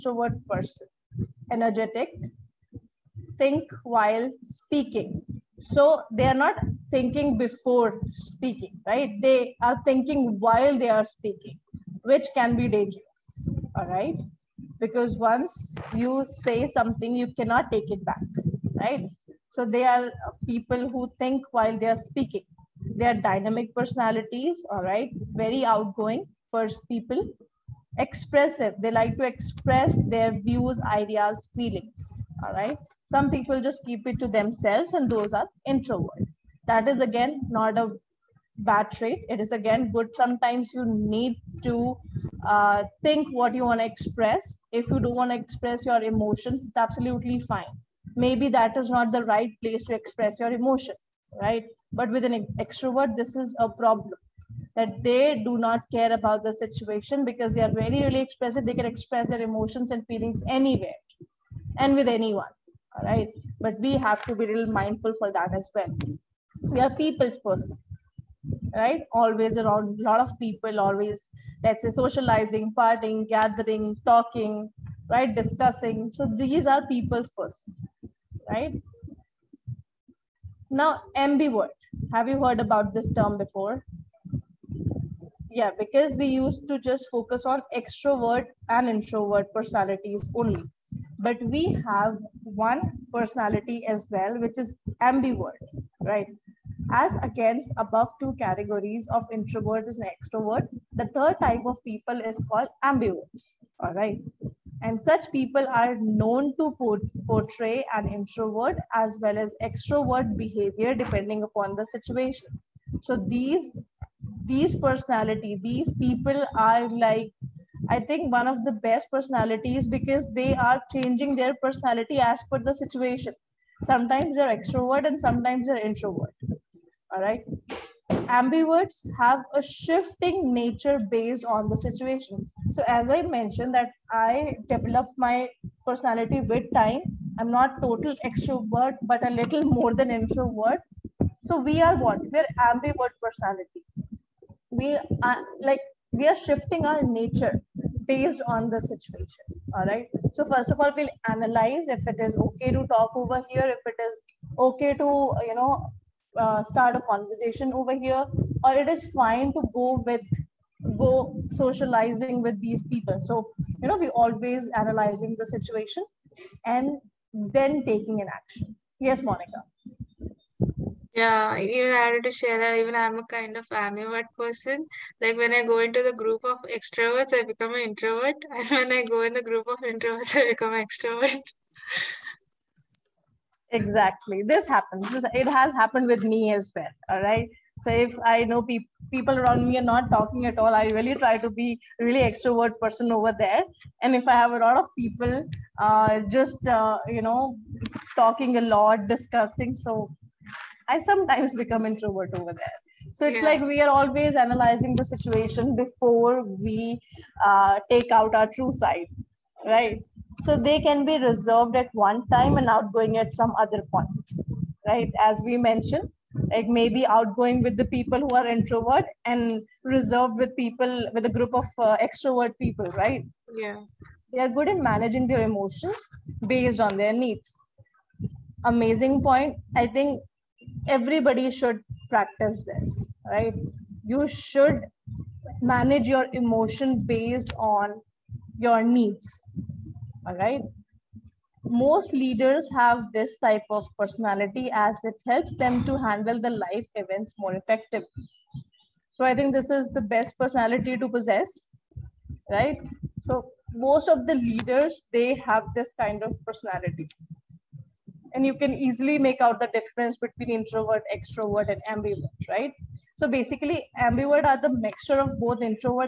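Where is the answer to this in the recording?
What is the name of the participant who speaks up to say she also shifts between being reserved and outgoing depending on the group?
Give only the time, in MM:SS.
02:49.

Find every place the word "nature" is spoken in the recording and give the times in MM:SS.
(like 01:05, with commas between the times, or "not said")
02:10, 02:27.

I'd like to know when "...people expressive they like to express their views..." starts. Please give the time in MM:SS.
00:26.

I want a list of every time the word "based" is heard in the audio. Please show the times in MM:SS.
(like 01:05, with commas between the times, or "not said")
02:11, 02:28, 03:46, 03:57.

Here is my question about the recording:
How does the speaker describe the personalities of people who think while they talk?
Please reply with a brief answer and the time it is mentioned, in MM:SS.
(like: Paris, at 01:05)
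dynamic, at 00:23.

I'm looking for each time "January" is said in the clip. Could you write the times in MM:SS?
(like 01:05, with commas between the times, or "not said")
not said.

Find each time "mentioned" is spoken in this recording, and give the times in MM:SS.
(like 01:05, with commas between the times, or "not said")
02:13, 03:35.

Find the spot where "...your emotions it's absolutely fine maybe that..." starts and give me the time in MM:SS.
00:45.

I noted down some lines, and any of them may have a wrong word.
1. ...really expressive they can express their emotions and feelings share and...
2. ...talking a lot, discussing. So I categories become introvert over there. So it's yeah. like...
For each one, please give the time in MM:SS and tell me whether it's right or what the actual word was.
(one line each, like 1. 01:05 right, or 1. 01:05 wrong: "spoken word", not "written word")
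1. 00:58 wrong: "anywhere", not "share"
2. 03:18 wrong: "sometimes", not "categories".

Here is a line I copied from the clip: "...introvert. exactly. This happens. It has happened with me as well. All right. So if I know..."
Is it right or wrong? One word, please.
wrong.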